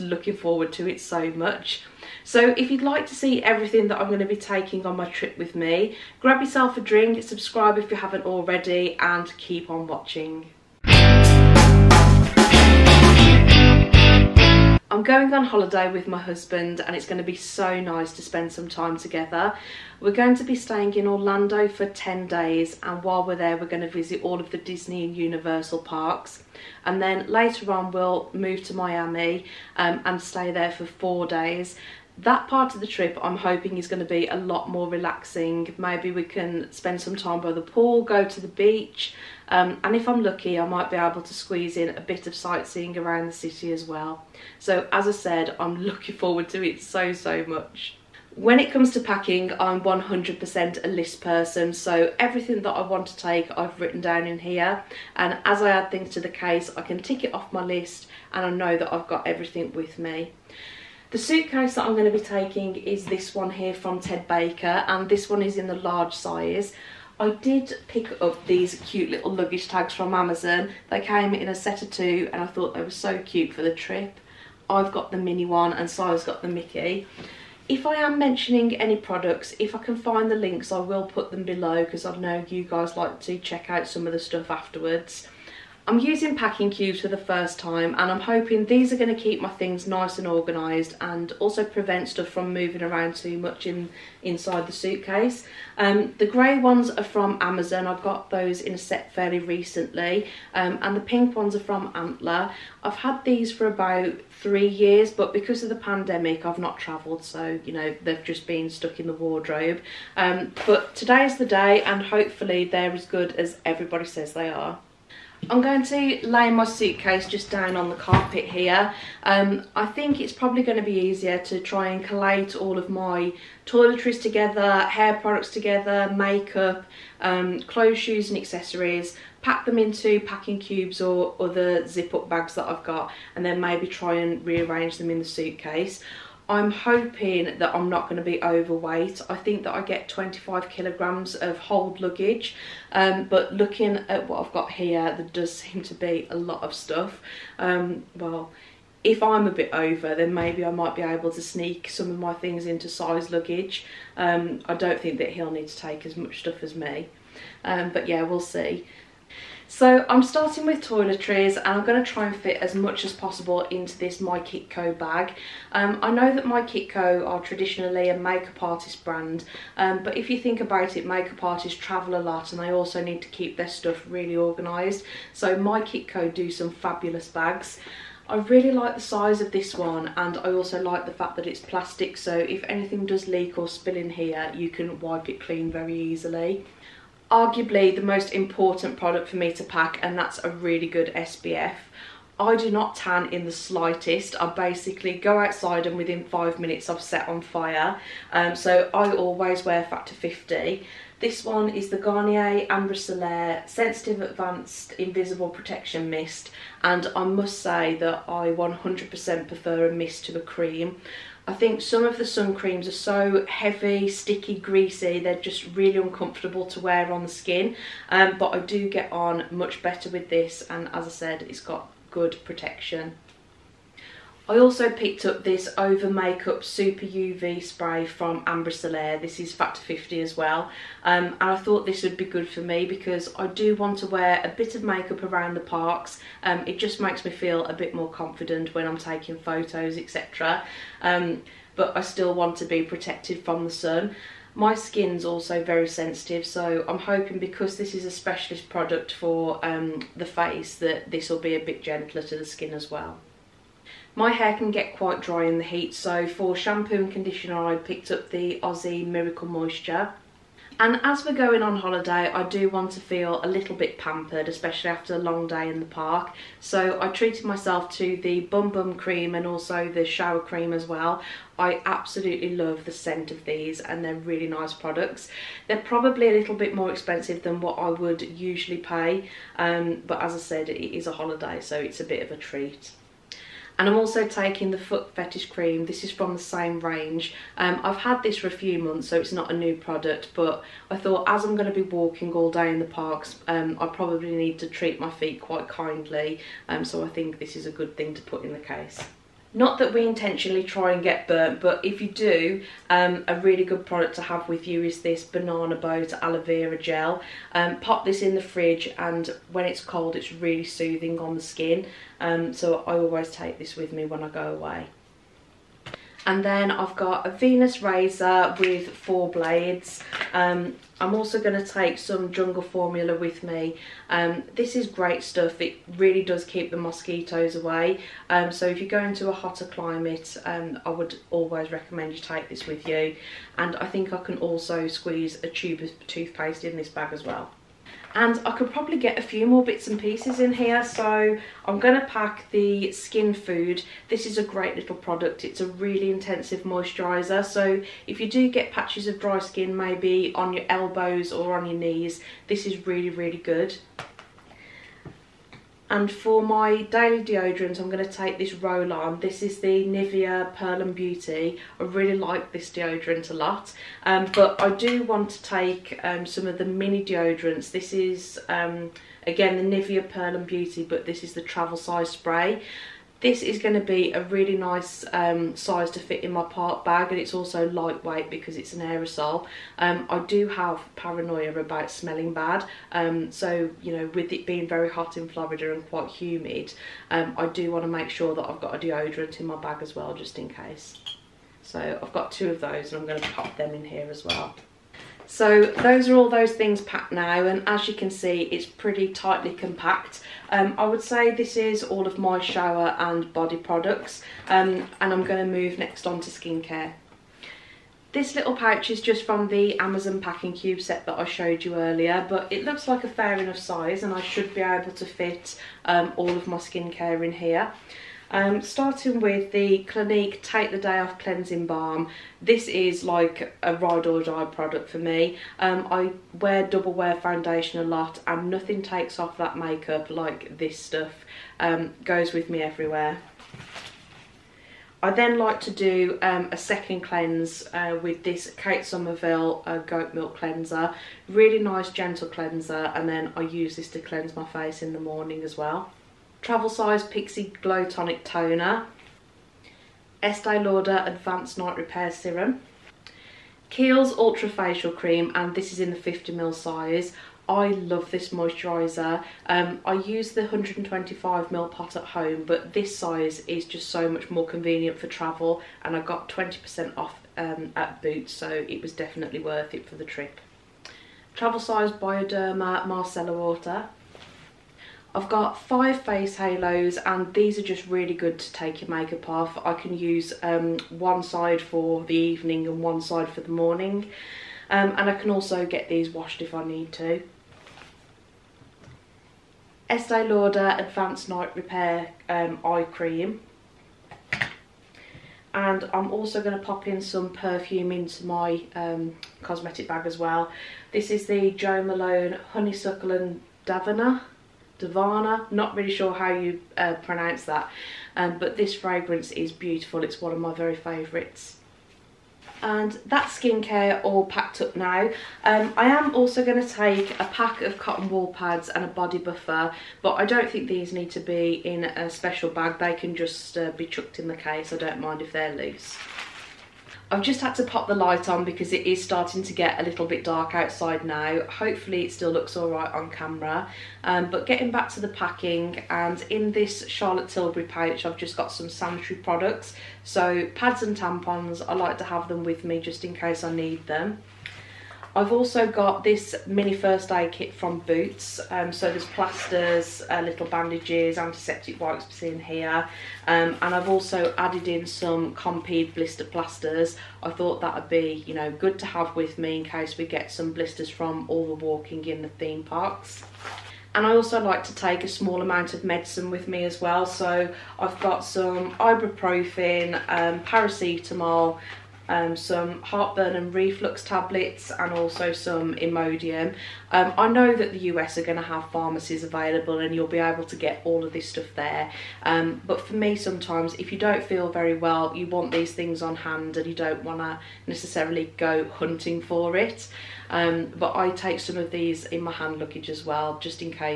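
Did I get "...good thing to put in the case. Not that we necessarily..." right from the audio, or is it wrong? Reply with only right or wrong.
wrong.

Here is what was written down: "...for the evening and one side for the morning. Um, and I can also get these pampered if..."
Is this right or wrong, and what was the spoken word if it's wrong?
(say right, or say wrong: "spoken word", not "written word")
wrong: "washed", not "pampered".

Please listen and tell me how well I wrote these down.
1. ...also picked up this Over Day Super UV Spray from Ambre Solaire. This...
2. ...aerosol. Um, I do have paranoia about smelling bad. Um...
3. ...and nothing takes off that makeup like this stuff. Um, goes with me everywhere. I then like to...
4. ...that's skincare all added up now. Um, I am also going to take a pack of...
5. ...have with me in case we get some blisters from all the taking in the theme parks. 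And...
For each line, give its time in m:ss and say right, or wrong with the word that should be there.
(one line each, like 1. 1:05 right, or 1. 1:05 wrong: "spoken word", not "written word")
1. 3:44 wrong: "Makeup", not "Day"
2. 6:18 right
3. 7:08 right
4. 8:33 wrong: "packed", not "added"
5. 9:18 wrong: "walking", not "taking".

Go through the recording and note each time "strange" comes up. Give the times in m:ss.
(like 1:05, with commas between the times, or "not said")
not said.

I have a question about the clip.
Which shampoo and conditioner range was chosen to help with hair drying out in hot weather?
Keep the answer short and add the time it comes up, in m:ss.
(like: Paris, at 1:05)
Aussie Miracle Moisture, at 4:18.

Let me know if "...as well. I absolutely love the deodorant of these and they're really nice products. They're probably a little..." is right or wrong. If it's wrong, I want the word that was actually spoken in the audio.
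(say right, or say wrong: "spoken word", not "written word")
wrong: "scent", not "deodorant".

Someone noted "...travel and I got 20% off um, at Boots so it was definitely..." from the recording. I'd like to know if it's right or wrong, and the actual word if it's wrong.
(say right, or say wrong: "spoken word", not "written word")
right.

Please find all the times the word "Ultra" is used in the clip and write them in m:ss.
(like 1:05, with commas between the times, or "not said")
7:34.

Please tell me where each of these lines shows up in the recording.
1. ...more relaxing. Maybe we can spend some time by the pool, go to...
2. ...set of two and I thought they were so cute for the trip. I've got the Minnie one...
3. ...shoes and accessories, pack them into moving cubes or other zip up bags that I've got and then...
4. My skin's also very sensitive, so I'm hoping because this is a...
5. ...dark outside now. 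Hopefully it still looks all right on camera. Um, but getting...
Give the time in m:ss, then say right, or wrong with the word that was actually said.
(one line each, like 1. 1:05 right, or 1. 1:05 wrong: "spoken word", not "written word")
1. 0:34 right
2. 1:11 right
3. 2:07 wrong: "packing", not "moving"
4. 4:04 right
5. 8:50 right.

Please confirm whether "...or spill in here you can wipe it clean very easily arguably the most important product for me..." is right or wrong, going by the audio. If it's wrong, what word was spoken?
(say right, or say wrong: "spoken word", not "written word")
right.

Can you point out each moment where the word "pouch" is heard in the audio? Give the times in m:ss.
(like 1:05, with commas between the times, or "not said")
6:48, 8:57.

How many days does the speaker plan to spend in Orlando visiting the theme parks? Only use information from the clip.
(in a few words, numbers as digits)
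10.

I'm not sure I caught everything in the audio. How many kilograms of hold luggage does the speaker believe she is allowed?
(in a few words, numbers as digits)
25.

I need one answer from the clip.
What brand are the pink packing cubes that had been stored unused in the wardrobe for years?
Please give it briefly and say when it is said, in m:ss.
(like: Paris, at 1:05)
Antler, at 1:41.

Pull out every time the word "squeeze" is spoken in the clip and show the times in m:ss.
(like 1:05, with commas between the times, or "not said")
0:41, 5:34.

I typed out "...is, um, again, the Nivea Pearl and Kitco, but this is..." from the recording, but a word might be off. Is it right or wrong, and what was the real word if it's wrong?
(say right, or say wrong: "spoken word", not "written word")
wrong: "Beauty", not "Kitco".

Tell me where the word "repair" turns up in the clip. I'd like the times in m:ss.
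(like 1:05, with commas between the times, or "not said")
7:31, 8:11.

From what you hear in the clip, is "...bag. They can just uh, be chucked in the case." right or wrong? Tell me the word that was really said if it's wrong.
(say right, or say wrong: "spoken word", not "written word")
right.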